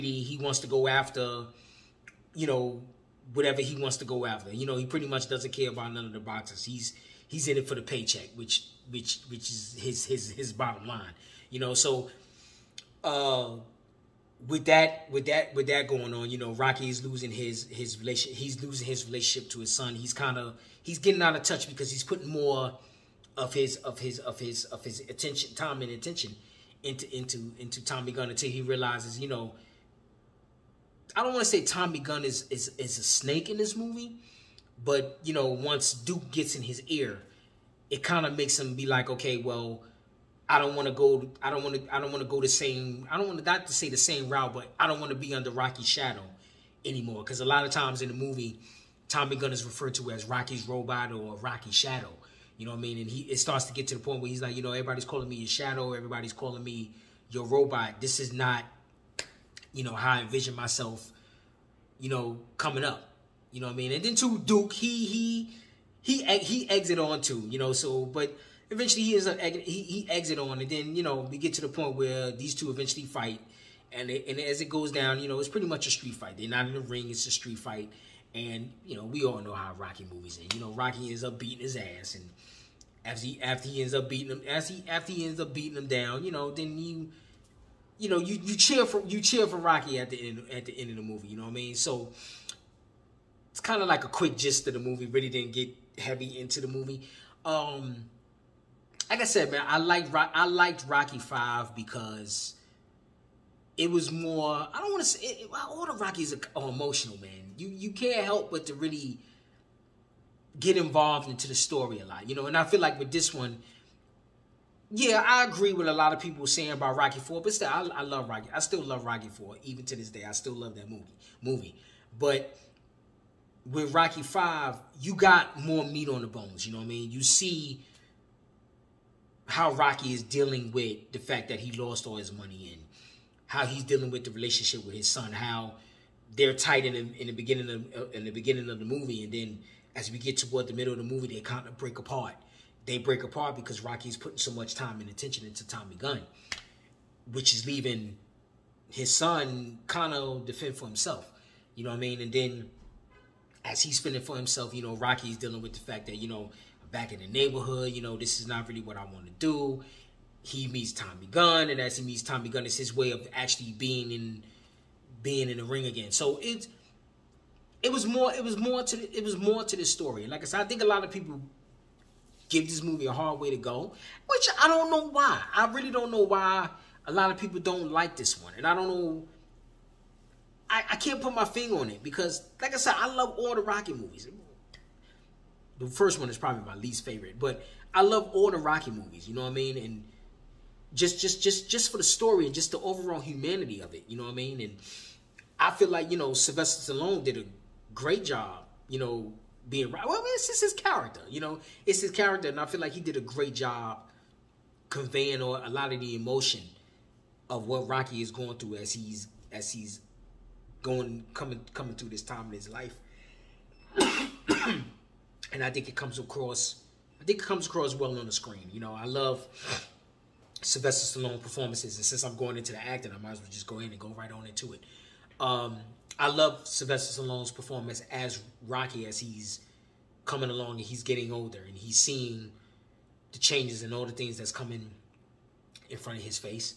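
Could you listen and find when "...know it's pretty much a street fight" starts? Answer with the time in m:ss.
1:15.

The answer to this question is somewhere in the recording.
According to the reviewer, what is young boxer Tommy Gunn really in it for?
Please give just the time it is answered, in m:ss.
0:07.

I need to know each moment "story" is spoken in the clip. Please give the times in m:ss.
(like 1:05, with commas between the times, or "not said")
1:51, 2:49, 3:12.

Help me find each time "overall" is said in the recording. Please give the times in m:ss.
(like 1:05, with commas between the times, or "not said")
3:12.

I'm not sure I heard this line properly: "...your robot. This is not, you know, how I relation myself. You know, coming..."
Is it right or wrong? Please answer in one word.
wrong.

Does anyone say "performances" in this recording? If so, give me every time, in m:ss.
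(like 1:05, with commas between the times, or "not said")
3:41, 3:47.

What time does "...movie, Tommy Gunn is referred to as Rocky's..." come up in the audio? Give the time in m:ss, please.
0:48.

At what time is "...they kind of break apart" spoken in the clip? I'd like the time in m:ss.
2:21.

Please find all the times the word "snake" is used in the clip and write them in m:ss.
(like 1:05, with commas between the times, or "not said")
0:33.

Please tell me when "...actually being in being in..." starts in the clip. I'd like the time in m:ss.
2:43.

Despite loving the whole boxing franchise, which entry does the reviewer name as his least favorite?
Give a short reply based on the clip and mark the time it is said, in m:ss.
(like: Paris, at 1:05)
The first one, at 3:05.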